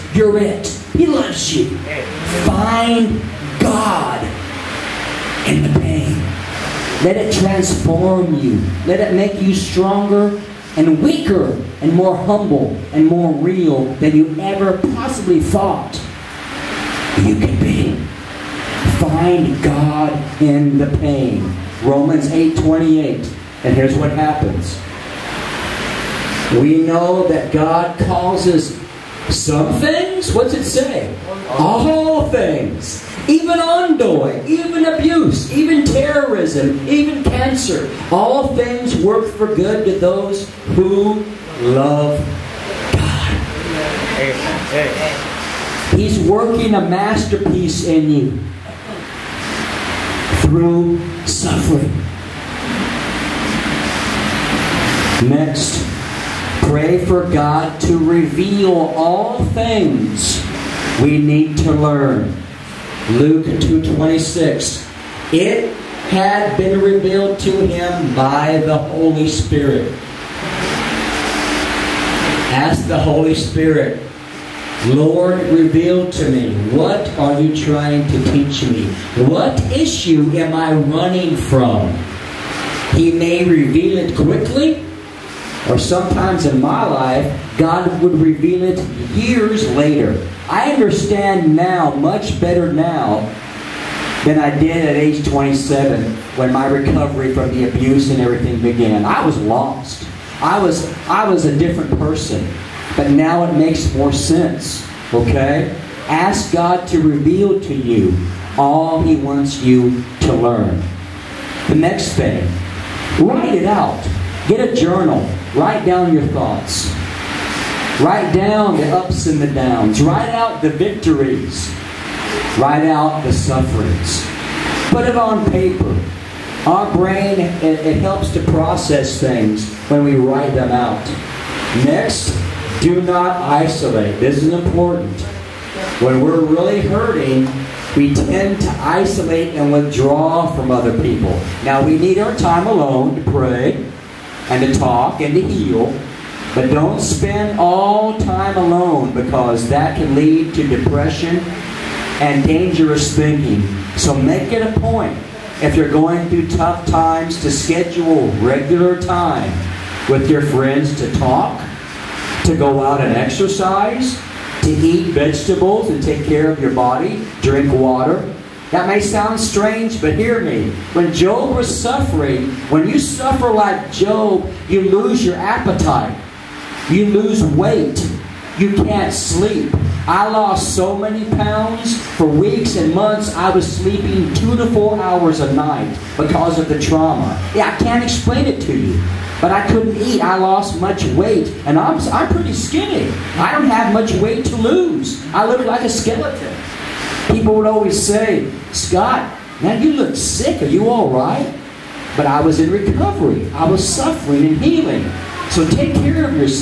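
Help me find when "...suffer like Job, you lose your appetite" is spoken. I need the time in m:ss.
2:52.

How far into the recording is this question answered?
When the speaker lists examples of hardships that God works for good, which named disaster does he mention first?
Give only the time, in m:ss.
0:33.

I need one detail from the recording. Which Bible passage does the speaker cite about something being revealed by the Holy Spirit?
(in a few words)
Luke 2:26.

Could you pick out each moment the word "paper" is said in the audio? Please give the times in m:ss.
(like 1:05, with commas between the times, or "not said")
2:05.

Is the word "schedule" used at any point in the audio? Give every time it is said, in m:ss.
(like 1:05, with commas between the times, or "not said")
2:37.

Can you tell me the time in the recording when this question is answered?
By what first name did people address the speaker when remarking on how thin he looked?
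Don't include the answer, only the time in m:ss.
3:18.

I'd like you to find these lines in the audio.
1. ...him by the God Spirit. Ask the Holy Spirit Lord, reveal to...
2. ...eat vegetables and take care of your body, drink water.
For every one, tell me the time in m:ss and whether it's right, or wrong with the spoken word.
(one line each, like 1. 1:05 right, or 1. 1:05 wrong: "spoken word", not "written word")
1. 1:07 wrong: "Holy", not "God"
2. 2:44 right.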